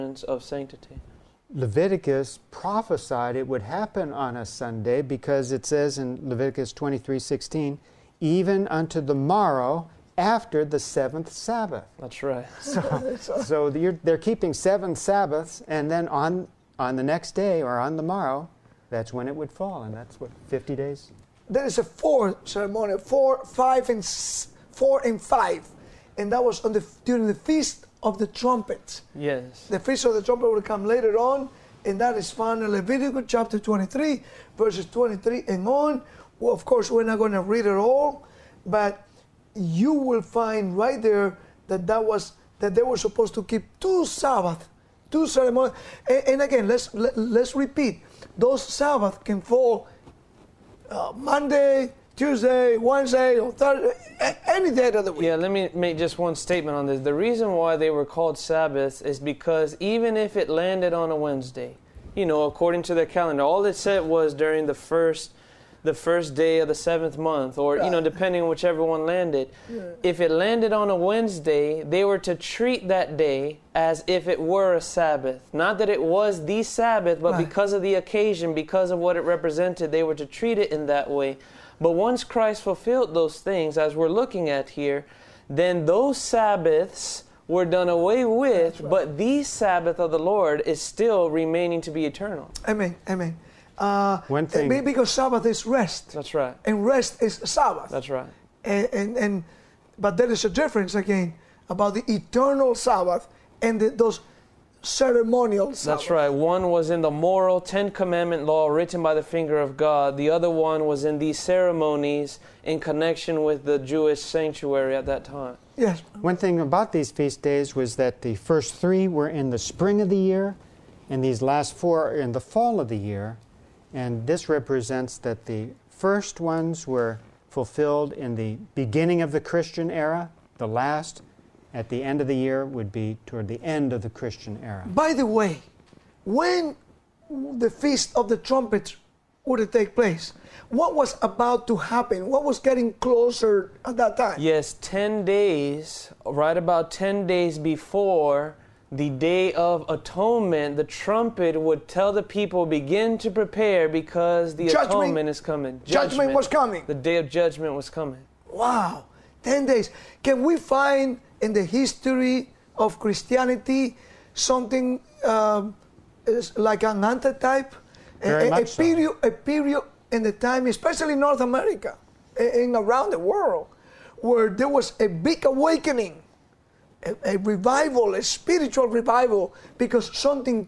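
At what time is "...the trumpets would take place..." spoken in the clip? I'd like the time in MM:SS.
02:18.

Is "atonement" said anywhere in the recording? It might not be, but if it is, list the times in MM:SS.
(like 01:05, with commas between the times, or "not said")
02:29, 02:34.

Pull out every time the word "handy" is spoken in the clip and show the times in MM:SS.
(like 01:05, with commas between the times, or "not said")
not said.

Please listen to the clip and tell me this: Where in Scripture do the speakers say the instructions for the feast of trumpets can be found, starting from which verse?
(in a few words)
Leviticus 23, verse 23.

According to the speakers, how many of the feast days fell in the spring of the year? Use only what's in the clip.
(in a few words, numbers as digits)
3.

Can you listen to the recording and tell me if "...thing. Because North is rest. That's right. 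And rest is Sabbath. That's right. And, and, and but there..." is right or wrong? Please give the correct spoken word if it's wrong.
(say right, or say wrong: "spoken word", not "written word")
wrong: "Sabbath", not "North".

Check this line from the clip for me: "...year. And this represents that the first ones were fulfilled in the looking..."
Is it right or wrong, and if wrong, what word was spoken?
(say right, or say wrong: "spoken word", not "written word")
wrong: "beginning", not "looking".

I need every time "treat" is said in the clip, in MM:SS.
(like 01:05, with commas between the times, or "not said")
01:12, 01:20.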